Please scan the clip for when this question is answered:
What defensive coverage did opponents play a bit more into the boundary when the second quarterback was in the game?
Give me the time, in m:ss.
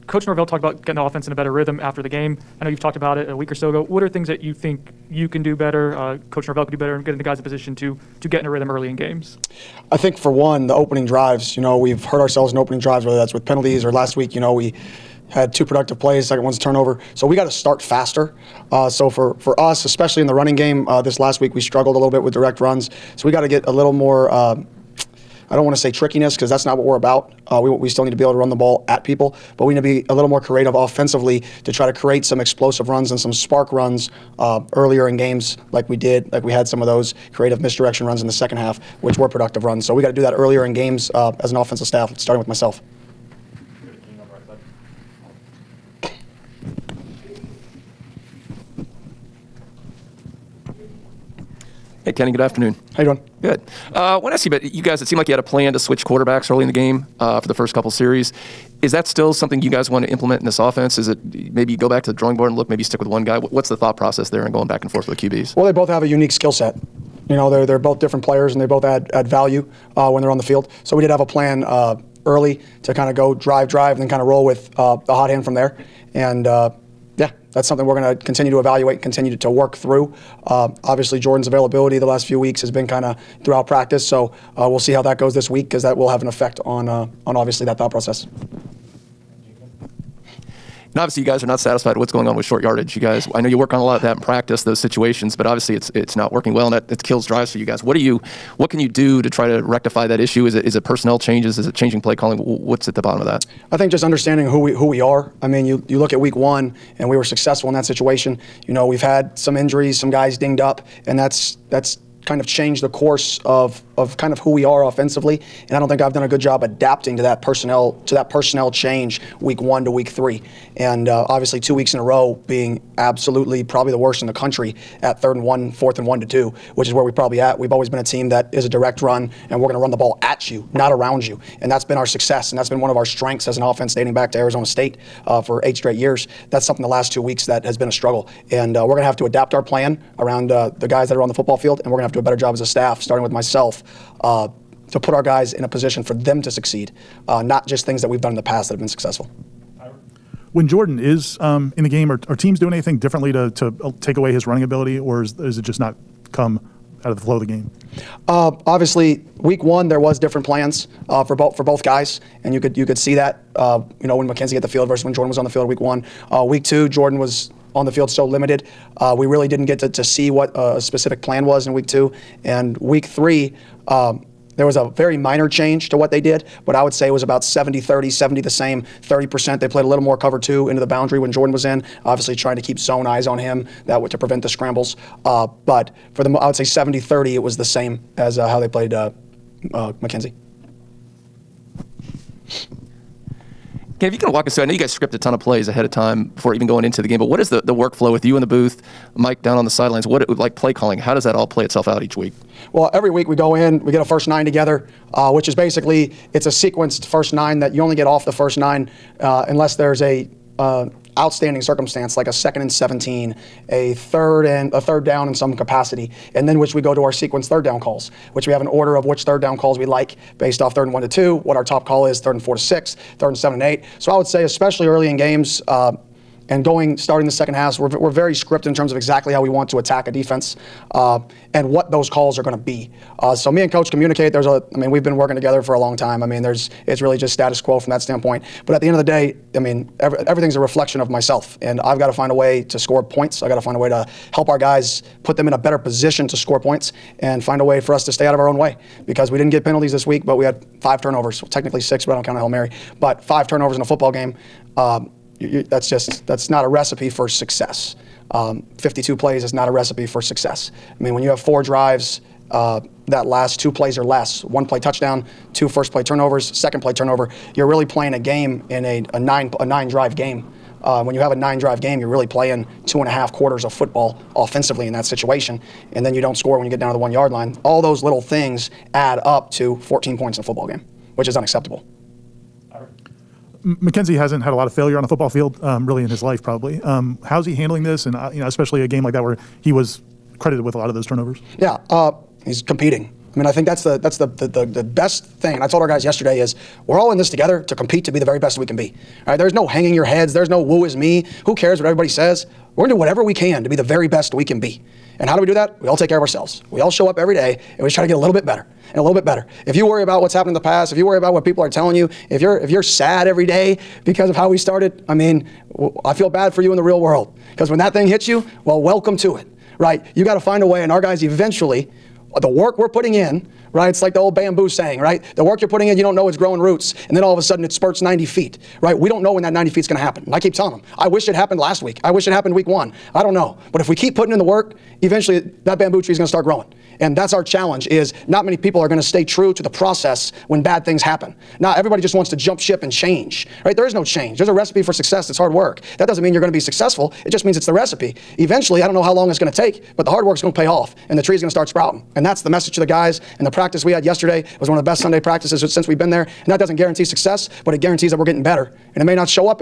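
3:00.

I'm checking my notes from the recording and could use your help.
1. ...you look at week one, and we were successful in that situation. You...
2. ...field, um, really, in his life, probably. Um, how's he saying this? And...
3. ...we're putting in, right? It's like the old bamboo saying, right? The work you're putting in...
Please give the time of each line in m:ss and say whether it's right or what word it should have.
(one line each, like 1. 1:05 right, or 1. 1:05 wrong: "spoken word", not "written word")
1. 1:45 right
2. 4:45 wrong: "handling", not "saying"
3. 5:22 right.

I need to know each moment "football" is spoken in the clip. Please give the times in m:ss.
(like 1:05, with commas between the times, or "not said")
2:21, 4:13, 4:33, 4:40, 4:45.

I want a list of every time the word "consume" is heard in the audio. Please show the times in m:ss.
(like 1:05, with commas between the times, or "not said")
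not said.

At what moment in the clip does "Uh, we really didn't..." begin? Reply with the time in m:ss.
2:48.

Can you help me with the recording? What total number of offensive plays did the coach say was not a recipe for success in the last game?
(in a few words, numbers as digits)
52.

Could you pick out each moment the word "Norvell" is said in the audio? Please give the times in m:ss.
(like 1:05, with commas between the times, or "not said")
0:00, 0:06.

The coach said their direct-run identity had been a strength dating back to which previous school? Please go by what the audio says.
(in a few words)
Arizona State.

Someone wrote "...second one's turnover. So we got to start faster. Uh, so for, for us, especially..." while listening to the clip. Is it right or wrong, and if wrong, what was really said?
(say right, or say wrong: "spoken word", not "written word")
right.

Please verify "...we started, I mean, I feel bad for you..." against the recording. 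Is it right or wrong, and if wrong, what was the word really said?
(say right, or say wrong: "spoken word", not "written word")
right.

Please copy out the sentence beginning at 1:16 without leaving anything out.
And uh, yeah, that's something we're going to continue to evaluate, continue to, to work through.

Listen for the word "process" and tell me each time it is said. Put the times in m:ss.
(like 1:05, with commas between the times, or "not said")
1:03, 1:27, 5:39.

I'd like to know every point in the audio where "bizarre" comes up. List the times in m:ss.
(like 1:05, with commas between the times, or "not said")
not said.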